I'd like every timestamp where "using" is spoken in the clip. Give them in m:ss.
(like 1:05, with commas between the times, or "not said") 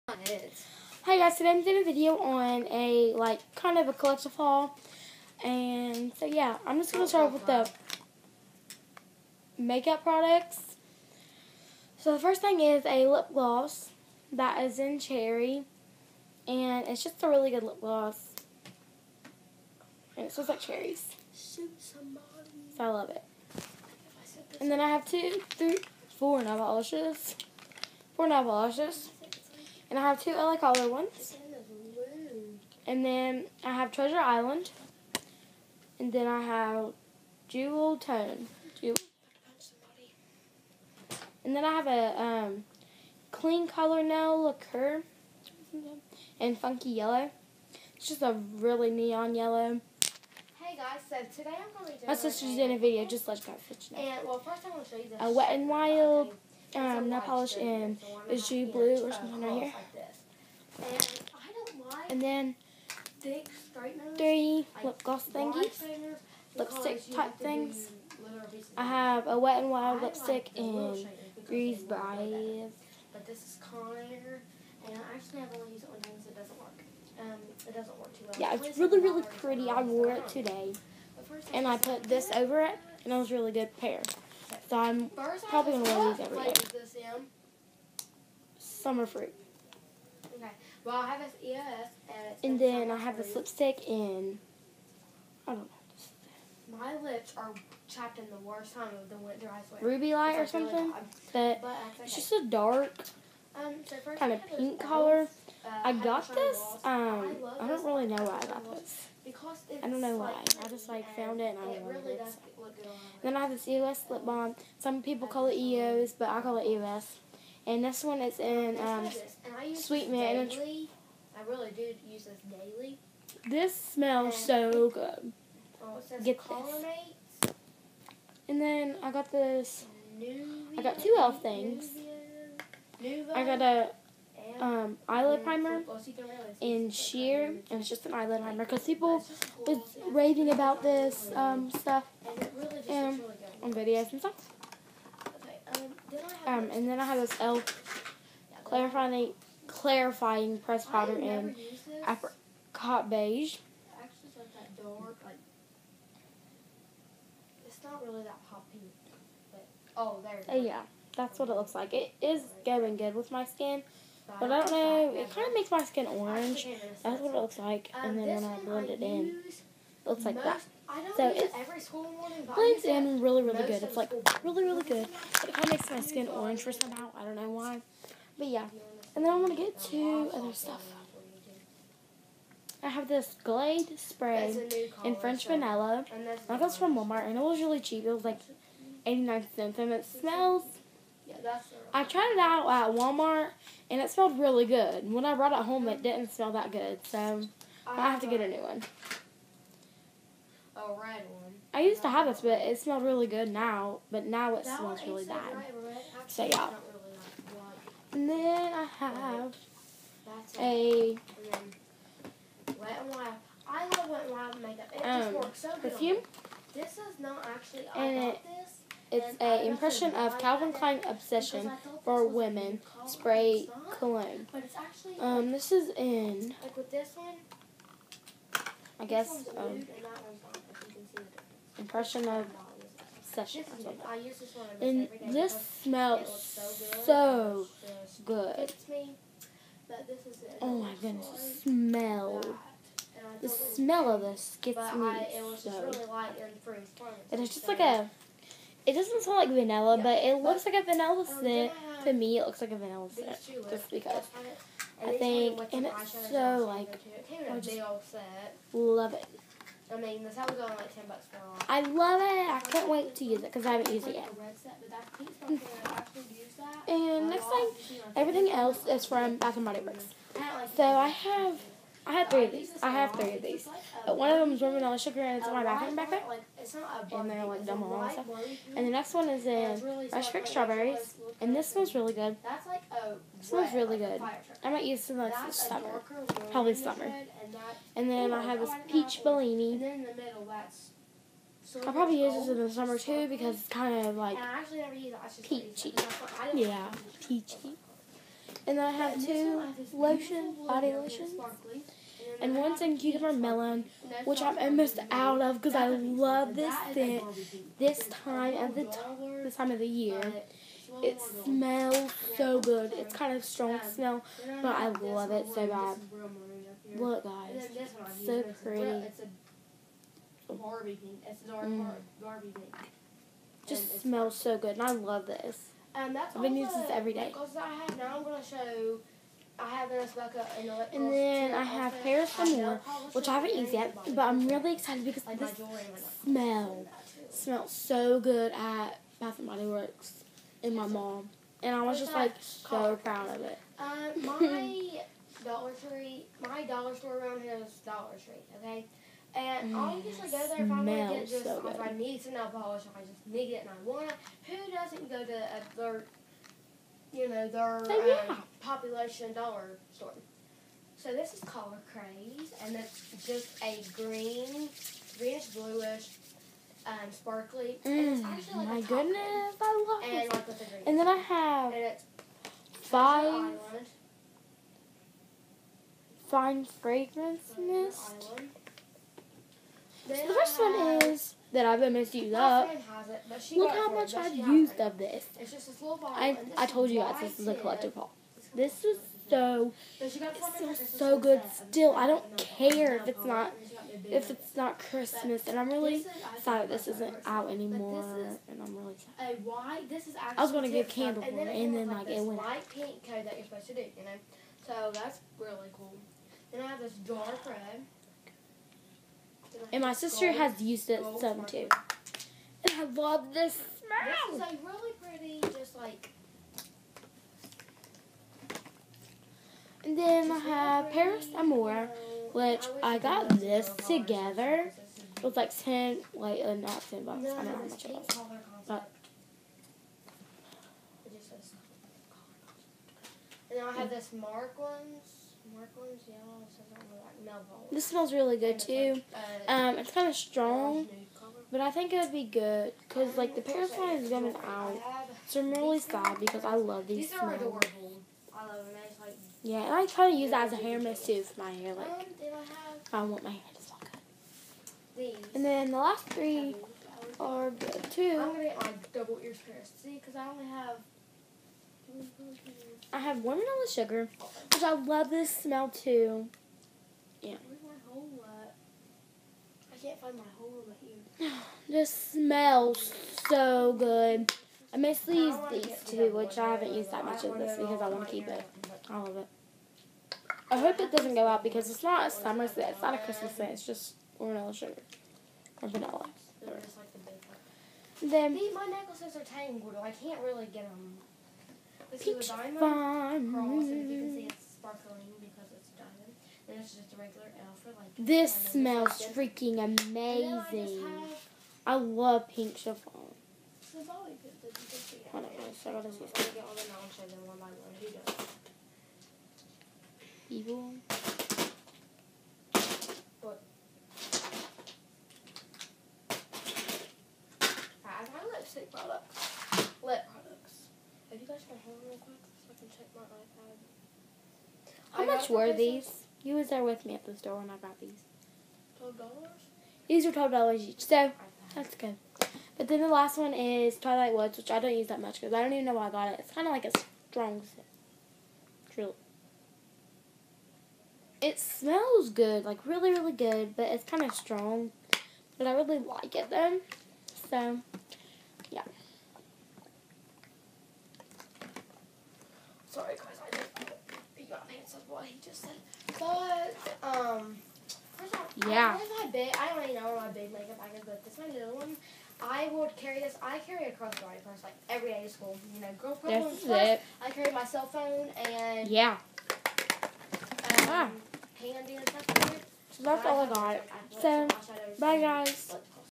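5:26.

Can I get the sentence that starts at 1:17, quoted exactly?
Um, it doesn't work too well.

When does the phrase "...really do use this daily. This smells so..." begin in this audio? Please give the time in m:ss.
2:01.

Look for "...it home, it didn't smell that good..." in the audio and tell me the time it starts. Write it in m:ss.
3:15.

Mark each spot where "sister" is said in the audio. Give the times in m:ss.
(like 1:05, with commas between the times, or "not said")
0:52, 6:49.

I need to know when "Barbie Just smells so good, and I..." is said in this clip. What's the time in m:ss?
5:22.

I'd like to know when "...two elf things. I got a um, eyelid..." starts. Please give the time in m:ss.
2:10.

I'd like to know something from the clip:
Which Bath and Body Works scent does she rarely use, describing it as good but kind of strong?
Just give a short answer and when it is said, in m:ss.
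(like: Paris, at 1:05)
Twilight Woods, at 8:53.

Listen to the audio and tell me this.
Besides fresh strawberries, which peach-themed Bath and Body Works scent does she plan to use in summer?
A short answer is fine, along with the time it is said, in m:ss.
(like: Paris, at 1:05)
Peach Bellini, at 4:48.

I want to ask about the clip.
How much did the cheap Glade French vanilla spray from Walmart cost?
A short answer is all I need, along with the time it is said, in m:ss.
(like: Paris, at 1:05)
89 cents, at 3:09.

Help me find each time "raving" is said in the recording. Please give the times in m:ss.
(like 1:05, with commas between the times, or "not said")
2:20.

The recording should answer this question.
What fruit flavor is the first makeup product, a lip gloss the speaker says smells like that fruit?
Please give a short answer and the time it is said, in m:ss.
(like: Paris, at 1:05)
Cherry, at 0:14.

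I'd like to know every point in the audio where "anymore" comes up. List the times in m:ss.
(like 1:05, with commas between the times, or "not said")
6:37.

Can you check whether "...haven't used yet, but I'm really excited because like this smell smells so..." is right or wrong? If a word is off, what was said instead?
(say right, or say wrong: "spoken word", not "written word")
right.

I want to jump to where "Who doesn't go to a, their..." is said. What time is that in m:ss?
5:54.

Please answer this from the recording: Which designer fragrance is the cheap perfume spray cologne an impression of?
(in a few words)
Calvin Klein Obsession.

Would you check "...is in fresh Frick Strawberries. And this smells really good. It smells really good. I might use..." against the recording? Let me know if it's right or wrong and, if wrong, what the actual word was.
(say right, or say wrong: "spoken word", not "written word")
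right.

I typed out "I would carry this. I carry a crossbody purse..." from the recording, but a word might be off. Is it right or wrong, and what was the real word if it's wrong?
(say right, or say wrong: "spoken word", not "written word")
right.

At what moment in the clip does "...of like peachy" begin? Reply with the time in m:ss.
4:54.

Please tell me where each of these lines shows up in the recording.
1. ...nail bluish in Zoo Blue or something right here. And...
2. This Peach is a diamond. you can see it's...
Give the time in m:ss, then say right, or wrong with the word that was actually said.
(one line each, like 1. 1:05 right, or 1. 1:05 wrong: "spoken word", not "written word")
1. 0:57 wrong: "polish", not "bluish"
2. 8:11 right.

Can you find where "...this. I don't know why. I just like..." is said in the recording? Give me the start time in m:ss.
1:48.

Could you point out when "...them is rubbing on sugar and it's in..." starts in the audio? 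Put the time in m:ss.
4:34.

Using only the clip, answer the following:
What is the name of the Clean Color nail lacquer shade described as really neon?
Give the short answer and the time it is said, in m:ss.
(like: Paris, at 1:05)
Funky Yellow, at 0:46.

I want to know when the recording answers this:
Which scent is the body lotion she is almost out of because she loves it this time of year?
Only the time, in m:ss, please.
5:02.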